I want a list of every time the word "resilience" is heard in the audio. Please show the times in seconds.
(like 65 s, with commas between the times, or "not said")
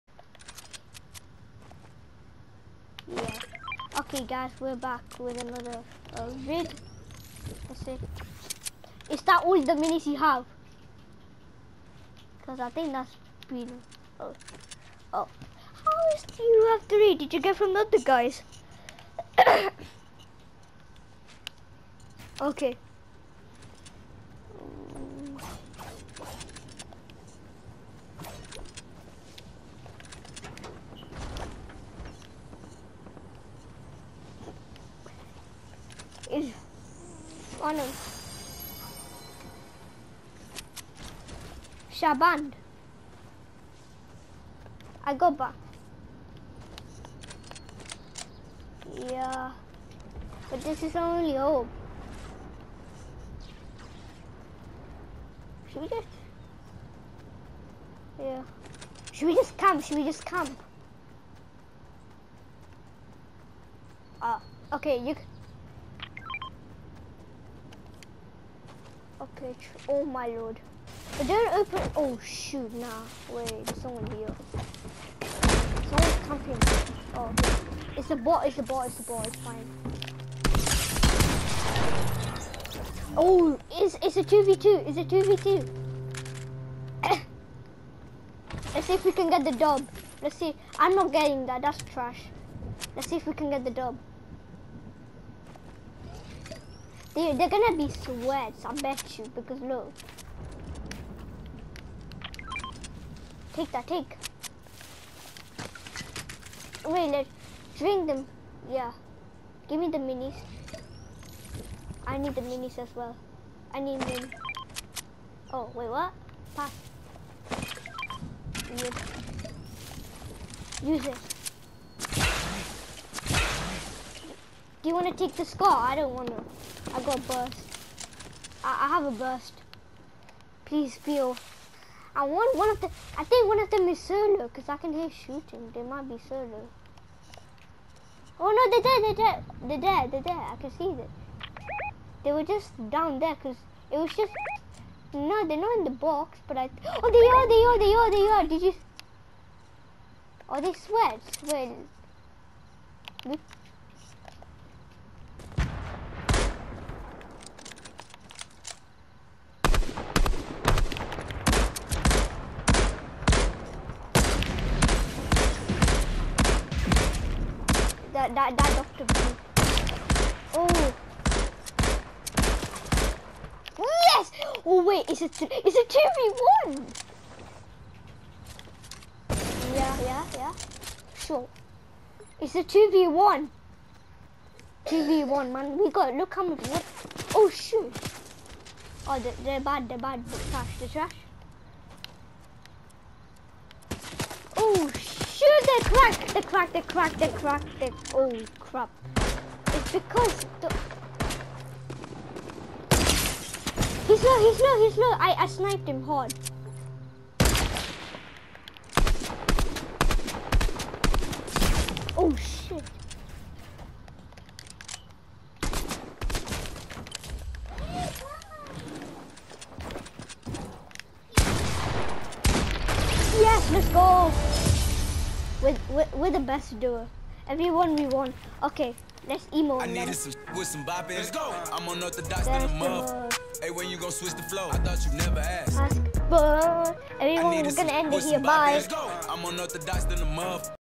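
not said.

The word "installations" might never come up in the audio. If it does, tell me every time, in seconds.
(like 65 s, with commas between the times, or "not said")
not said.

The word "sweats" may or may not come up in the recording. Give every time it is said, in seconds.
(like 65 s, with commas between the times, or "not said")
97 s, 150 s.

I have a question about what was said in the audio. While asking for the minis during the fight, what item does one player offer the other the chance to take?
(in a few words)
the skull.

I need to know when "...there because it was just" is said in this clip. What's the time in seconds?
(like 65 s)
143 s.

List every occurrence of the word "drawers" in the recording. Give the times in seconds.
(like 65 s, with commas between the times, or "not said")
not said.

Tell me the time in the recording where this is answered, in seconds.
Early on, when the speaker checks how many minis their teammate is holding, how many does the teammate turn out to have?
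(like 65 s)
16 s.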